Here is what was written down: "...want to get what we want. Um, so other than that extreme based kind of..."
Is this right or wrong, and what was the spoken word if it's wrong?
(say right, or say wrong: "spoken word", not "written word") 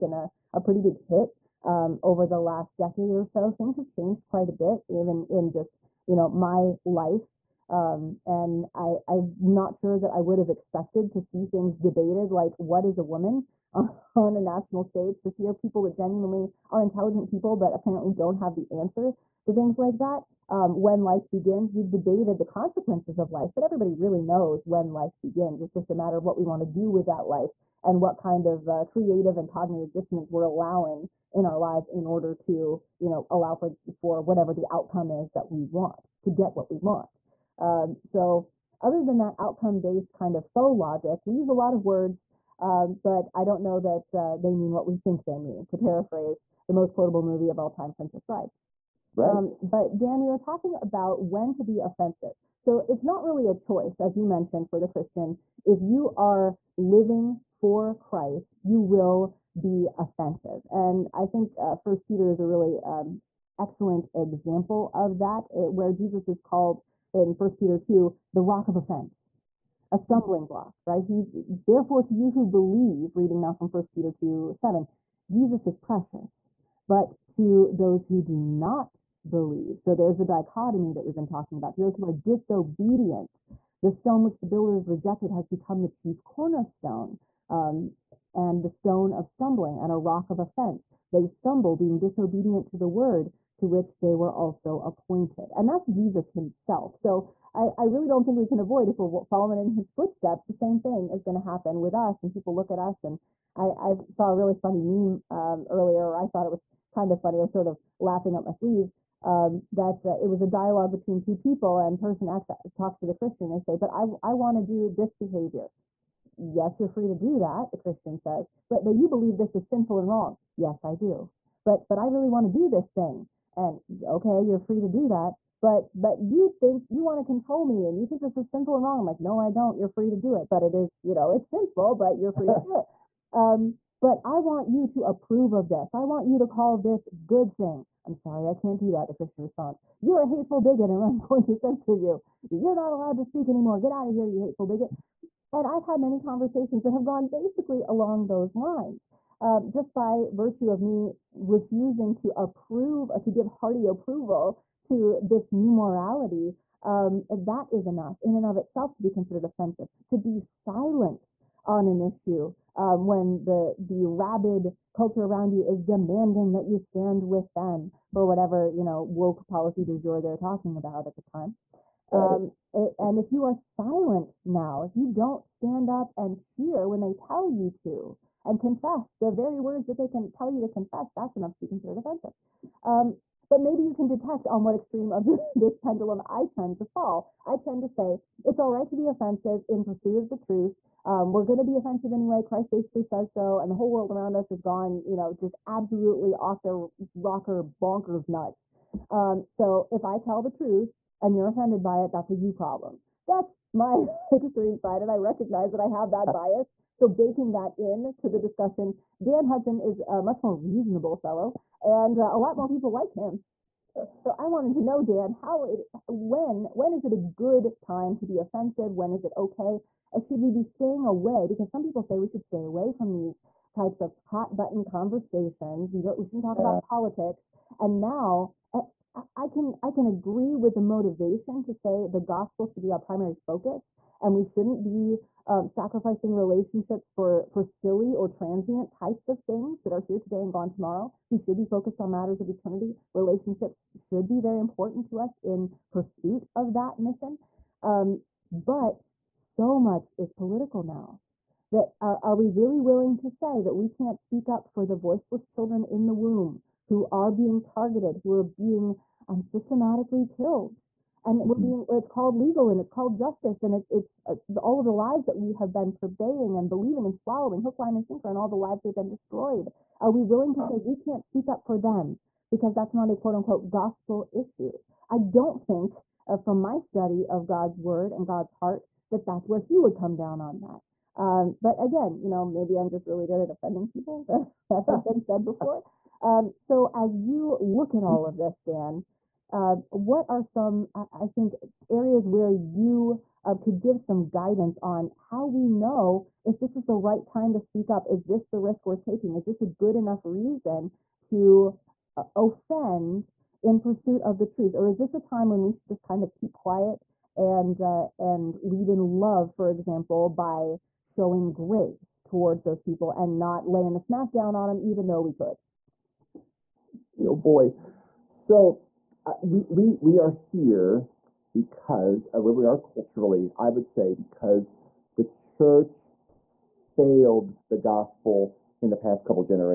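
wrong: "outcome", not "extreme".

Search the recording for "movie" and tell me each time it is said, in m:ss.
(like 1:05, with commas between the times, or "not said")
0:47.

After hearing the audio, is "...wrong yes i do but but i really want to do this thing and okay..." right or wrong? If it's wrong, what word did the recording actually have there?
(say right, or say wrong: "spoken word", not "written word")
right.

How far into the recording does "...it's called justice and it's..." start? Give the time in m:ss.
4:22.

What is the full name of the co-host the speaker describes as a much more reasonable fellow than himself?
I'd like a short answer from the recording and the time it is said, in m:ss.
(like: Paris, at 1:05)
Dan Hudson, at 3:29.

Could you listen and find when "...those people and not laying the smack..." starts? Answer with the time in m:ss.
5:12.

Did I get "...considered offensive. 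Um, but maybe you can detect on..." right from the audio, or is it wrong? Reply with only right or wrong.
right.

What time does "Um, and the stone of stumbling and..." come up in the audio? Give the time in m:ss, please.
1:27.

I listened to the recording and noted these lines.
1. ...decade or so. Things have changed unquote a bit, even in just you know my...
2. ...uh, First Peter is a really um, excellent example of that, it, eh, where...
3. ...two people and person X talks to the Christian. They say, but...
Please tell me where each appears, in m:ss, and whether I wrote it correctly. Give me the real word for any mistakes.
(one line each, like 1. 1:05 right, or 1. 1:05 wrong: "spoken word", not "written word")
1. 0:02 wrong: "quite", not "unquote"
2. 1:01 right
3. 1:51 right.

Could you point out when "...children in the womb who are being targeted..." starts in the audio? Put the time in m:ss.
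4:15.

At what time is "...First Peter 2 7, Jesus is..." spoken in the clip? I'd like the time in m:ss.
1:13.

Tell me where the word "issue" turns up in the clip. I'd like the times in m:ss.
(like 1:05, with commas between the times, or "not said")
2:42, 4:34.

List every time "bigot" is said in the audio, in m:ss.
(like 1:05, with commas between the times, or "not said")
2:20, 2:24.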